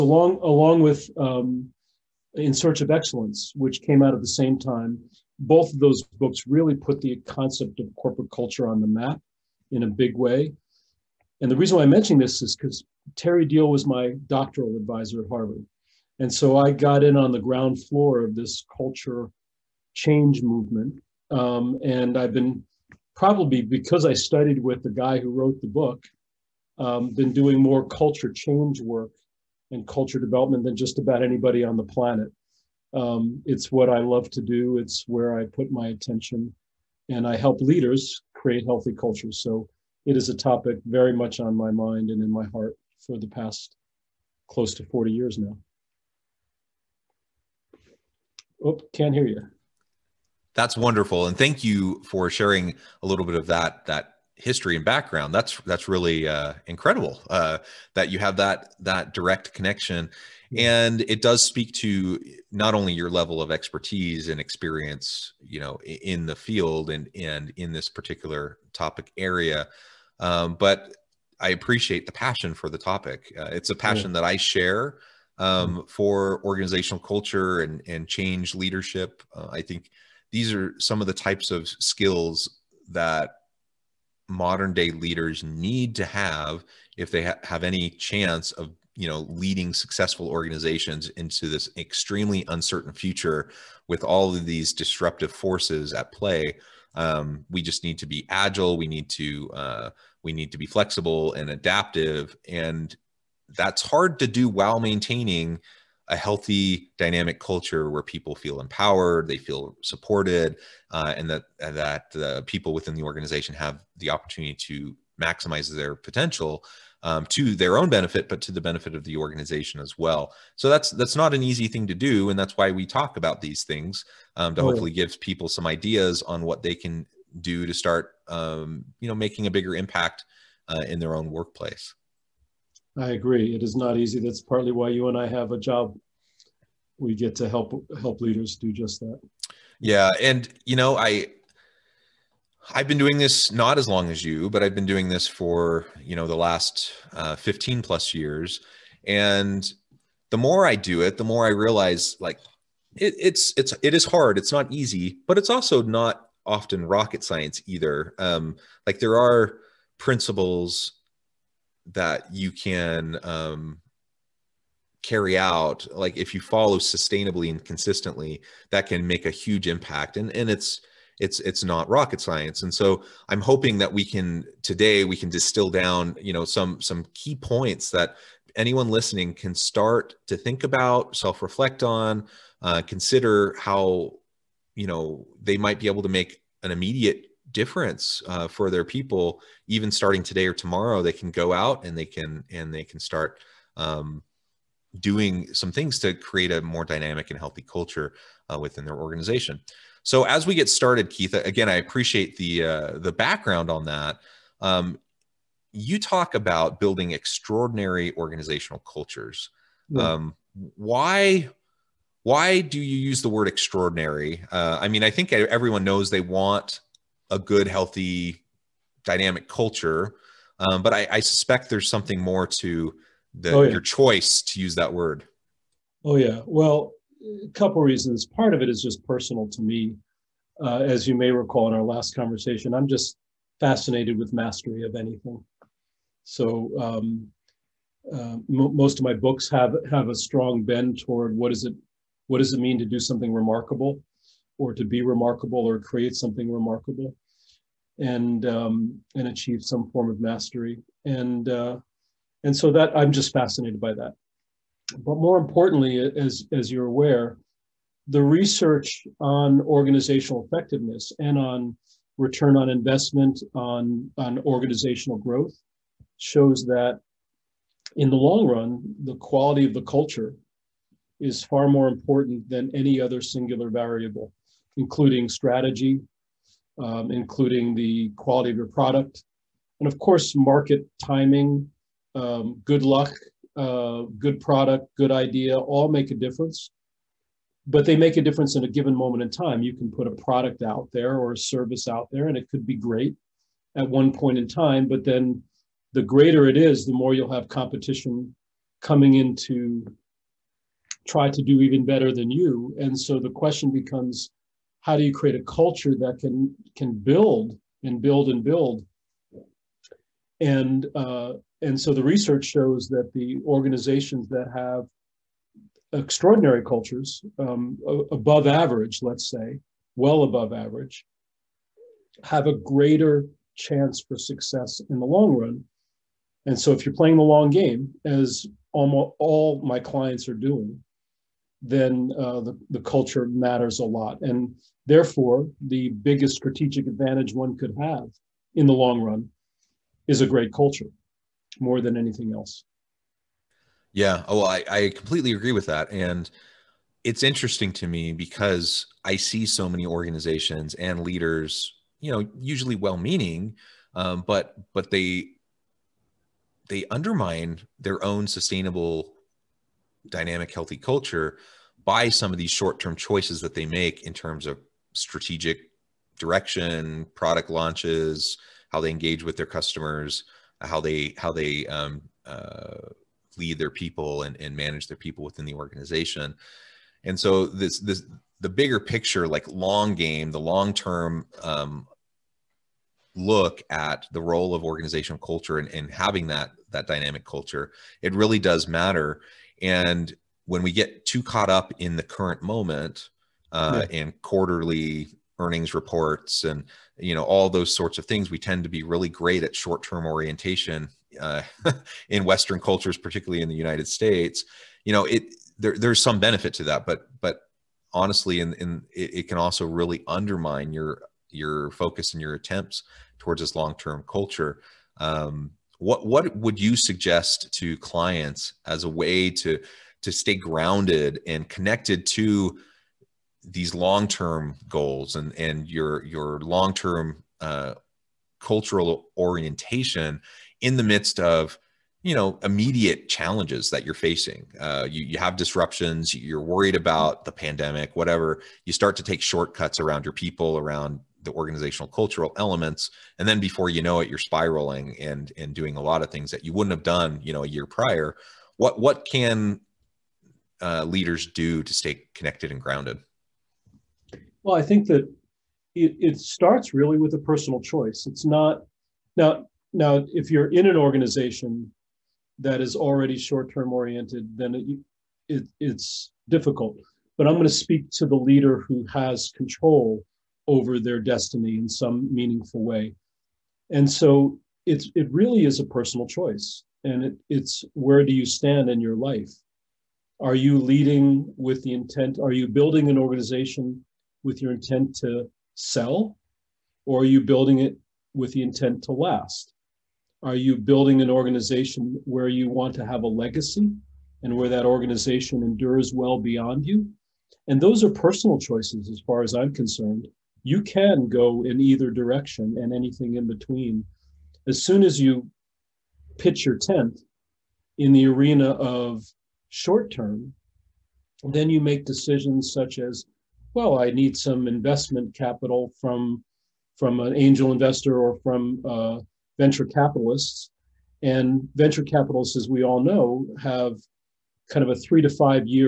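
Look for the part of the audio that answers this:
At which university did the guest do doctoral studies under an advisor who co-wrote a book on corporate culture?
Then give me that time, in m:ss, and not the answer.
0:15.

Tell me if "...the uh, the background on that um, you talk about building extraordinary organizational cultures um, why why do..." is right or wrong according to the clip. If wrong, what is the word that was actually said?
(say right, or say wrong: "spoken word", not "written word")
right.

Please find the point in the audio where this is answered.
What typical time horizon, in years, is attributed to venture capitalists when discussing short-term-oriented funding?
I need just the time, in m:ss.
8:44.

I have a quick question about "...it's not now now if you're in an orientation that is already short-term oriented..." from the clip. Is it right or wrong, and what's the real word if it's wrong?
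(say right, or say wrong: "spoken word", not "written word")
wrong: "organization", not "orientation".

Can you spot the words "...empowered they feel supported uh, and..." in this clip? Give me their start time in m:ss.
1:48.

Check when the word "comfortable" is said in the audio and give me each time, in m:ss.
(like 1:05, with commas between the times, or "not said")
not said.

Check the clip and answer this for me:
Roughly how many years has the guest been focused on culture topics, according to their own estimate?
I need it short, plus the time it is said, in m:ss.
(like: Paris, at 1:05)
close to 40 years, at 0:44.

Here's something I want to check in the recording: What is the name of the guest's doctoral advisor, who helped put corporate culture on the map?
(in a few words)
Terry Deal.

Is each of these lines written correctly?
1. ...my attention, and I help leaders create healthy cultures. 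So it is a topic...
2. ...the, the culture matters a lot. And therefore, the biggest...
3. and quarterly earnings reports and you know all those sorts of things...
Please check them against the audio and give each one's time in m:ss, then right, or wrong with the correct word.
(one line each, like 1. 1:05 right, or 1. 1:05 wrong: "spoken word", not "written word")
1. 0:35 right
2. 5:32 right
3. 6:34 right.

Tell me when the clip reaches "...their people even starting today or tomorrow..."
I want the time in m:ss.
3:08.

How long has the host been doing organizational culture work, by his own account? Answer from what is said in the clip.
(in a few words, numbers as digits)
15 plus years.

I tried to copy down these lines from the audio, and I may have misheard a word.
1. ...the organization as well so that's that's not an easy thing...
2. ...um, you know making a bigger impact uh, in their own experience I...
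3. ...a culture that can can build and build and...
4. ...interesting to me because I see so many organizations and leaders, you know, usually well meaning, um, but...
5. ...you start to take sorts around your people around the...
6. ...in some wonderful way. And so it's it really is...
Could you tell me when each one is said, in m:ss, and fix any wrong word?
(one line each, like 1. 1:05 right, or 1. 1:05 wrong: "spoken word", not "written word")
1. 1:59 right
2. 2:08 wrong: "workplace", not "experience"
3. 5:05 right
4. 5:47 right
5. 7:18 wrong: "shortcuts", not "sorts"
6. 7:51 wrong: "meaningful", not "wonderful".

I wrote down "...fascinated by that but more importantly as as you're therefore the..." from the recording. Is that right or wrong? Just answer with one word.
wrong.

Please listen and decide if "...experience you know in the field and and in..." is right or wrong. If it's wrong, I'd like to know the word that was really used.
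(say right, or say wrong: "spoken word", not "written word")
right.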